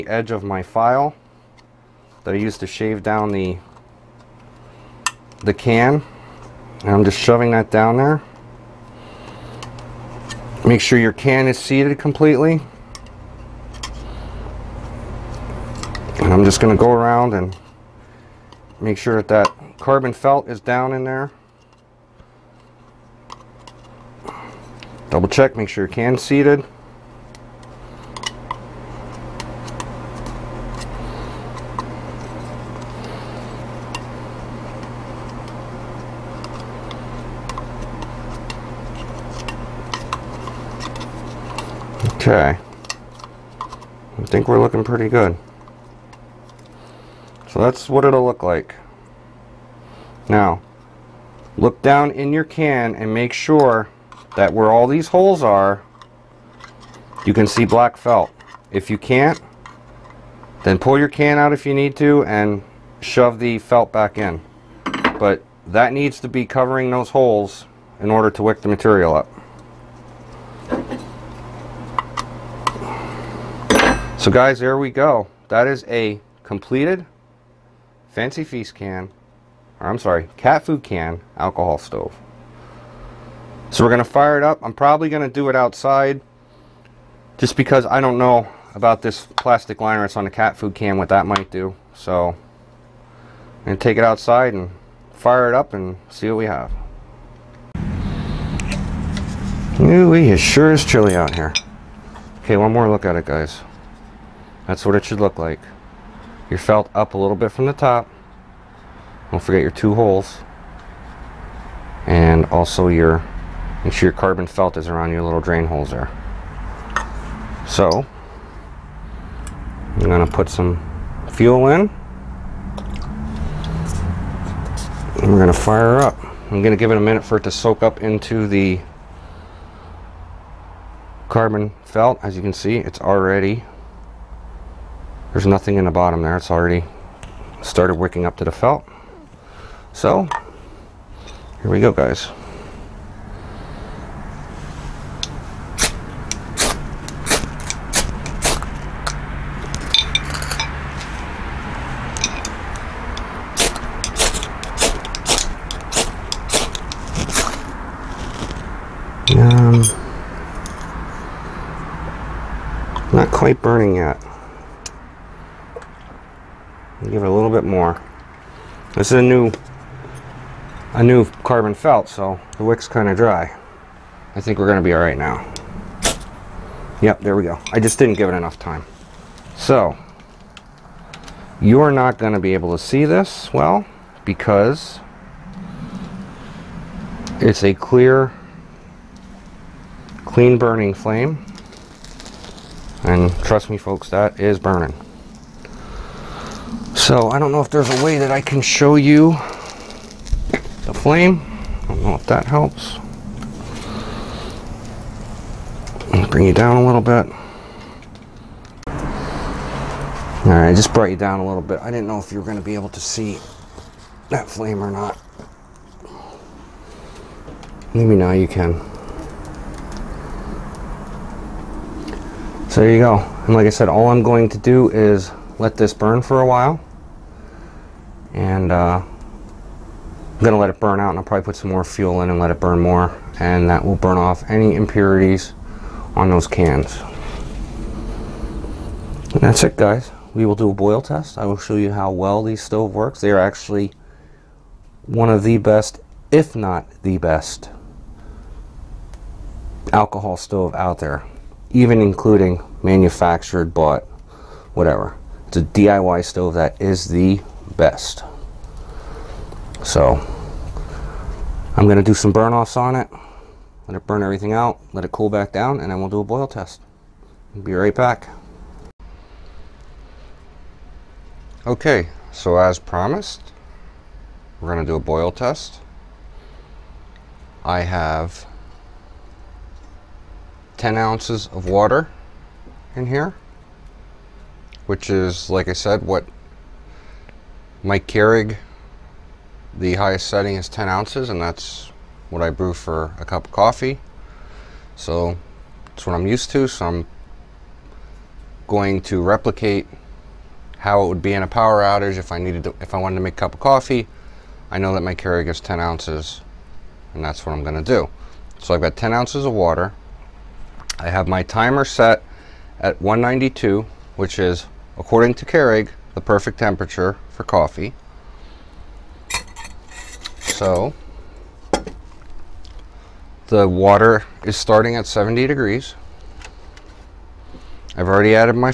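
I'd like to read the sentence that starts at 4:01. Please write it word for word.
I will show you how well these stove works.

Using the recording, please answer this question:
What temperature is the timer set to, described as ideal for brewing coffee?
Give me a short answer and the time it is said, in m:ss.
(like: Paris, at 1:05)
192, at 5:13.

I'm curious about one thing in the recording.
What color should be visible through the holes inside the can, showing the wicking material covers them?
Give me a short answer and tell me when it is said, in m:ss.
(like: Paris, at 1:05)
Black, at 0:57.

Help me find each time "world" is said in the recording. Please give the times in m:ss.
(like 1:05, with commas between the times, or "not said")
not said.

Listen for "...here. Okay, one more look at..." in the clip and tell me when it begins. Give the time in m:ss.
1:41.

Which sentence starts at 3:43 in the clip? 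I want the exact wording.
And like I said, all I'm going to do is let this burn for a while.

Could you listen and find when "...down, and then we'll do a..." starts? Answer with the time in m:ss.
4:25.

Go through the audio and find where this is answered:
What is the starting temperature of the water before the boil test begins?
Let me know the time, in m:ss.
5:25.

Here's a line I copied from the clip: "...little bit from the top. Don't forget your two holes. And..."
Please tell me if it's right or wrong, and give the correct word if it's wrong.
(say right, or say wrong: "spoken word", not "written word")
right.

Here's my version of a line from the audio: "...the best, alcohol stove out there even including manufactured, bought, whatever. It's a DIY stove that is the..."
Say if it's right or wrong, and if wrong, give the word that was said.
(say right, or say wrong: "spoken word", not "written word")
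right.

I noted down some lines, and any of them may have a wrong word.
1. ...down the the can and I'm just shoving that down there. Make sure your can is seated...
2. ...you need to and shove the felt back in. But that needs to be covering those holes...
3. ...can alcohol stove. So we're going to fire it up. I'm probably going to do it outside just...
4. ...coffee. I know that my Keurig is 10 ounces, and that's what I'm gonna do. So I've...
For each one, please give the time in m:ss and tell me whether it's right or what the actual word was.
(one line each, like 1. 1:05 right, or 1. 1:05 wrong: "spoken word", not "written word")
1. 0:03 right
2. 1:01 right
3. 1:20 right
4. 5:03 right.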